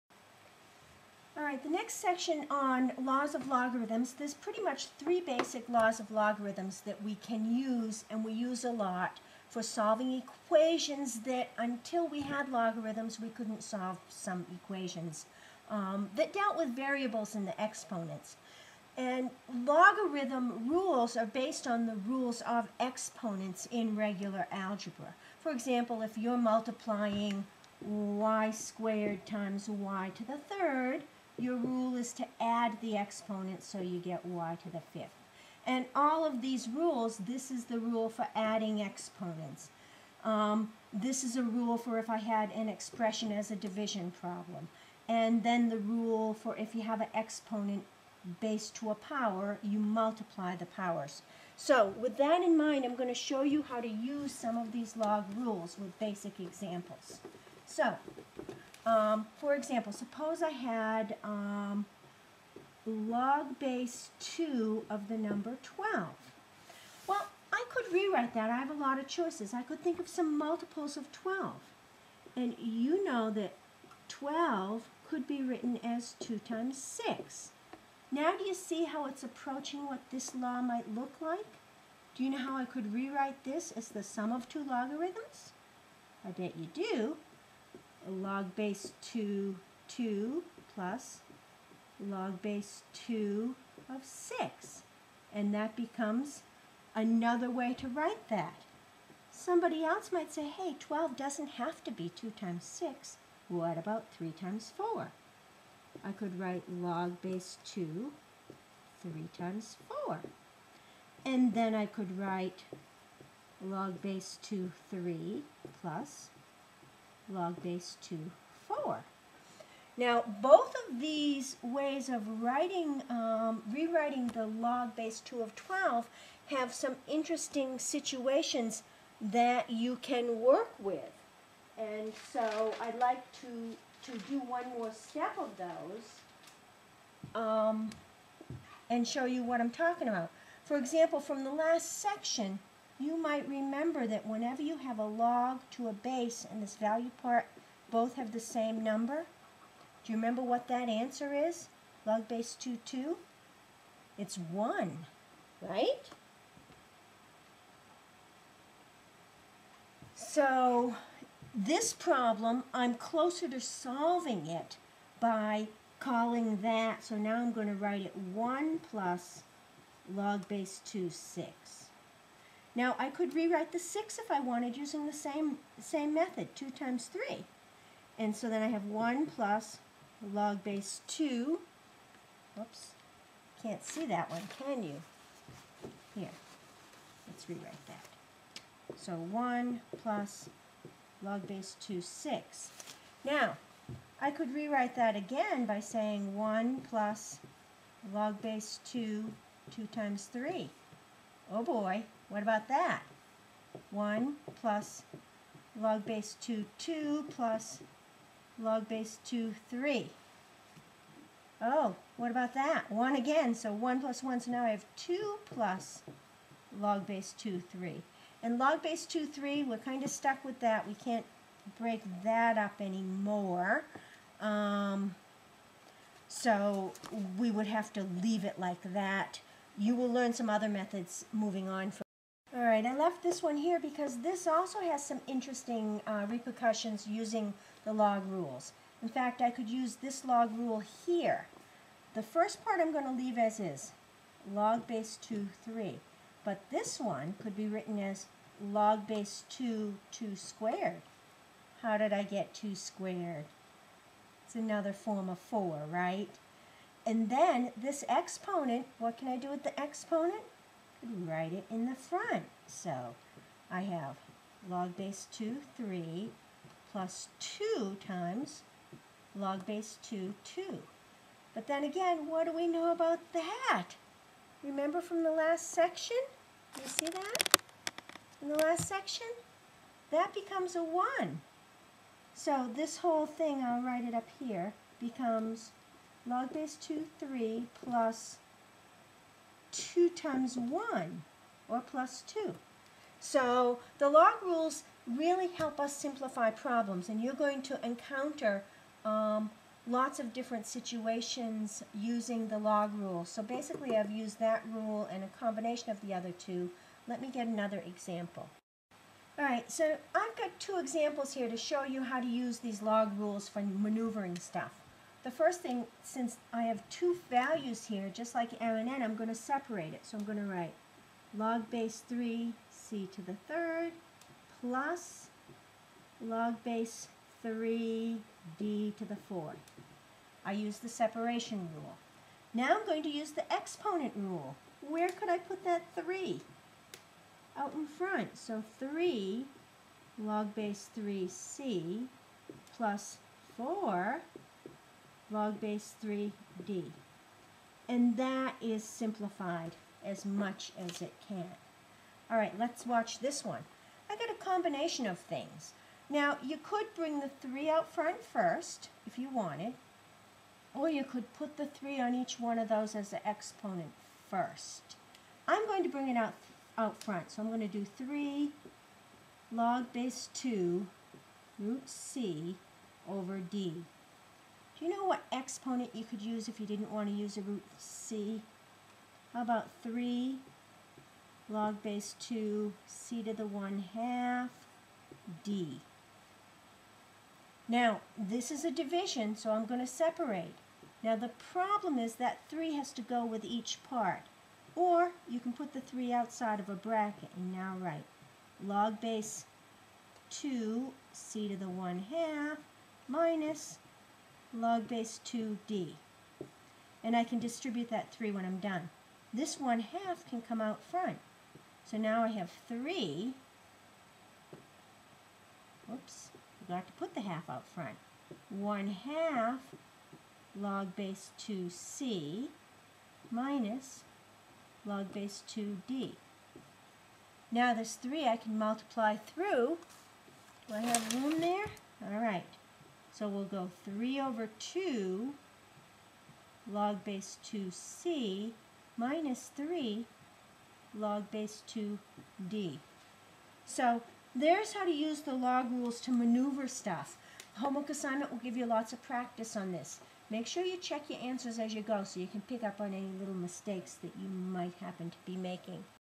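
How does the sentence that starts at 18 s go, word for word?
And logarithm rules are based on the rules of exponents in regular algebra.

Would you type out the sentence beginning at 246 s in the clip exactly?
But this one could be written as log base 2, 2 squared.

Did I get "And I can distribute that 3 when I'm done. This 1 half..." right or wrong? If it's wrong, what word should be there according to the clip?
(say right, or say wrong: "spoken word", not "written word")
right.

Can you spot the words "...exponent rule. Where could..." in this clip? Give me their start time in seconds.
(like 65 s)
333 s.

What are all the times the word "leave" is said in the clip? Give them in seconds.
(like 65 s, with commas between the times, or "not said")
228 s, 243 s.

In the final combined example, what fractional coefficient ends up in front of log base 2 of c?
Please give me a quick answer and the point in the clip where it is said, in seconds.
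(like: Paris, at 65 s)
3/2, at 433 s.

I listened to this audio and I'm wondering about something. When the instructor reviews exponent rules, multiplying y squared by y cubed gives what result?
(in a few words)
y to the fifth.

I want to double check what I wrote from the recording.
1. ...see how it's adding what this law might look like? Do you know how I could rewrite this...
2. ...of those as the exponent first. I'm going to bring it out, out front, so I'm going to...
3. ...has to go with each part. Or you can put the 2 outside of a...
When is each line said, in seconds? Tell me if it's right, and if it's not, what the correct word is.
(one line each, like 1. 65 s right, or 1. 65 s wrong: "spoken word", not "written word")
1. 78 s wrong: "approaching", not "adding"
2. 362 s right
3. 392 s wrong: "3", not "2".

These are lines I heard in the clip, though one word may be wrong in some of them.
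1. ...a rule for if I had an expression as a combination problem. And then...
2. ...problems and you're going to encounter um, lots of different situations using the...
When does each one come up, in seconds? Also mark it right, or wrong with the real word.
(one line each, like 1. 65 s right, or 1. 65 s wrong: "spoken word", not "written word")
1. 41 s wrong: "division", not "combination"
2. 296 s right.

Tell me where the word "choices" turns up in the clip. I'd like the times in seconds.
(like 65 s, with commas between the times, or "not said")
69 s.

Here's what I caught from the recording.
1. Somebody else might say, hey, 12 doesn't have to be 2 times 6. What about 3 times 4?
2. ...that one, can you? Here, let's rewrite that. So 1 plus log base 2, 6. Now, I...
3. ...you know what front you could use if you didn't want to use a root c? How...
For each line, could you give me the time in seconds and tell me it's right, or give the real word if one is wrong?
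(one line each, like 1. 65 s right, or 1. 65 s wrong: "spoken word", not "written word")
1. 99 s right
2. 184 s right
3. 374 s wrong: "exponent", not "front".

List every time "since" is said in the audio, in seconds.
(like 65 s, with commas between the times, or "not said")
316 s.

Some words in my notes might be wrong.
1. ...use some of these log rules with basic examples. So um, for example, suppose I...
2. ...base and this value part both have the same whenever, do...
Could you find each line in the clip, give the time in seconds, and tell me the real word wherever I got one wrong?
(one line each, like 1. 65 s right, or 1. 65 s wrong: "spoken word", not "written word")
1. 53 s right
2. 145 s wrong: "number", not "whenever".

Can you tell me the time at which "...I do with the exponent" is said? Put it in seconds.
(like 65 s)
259 s.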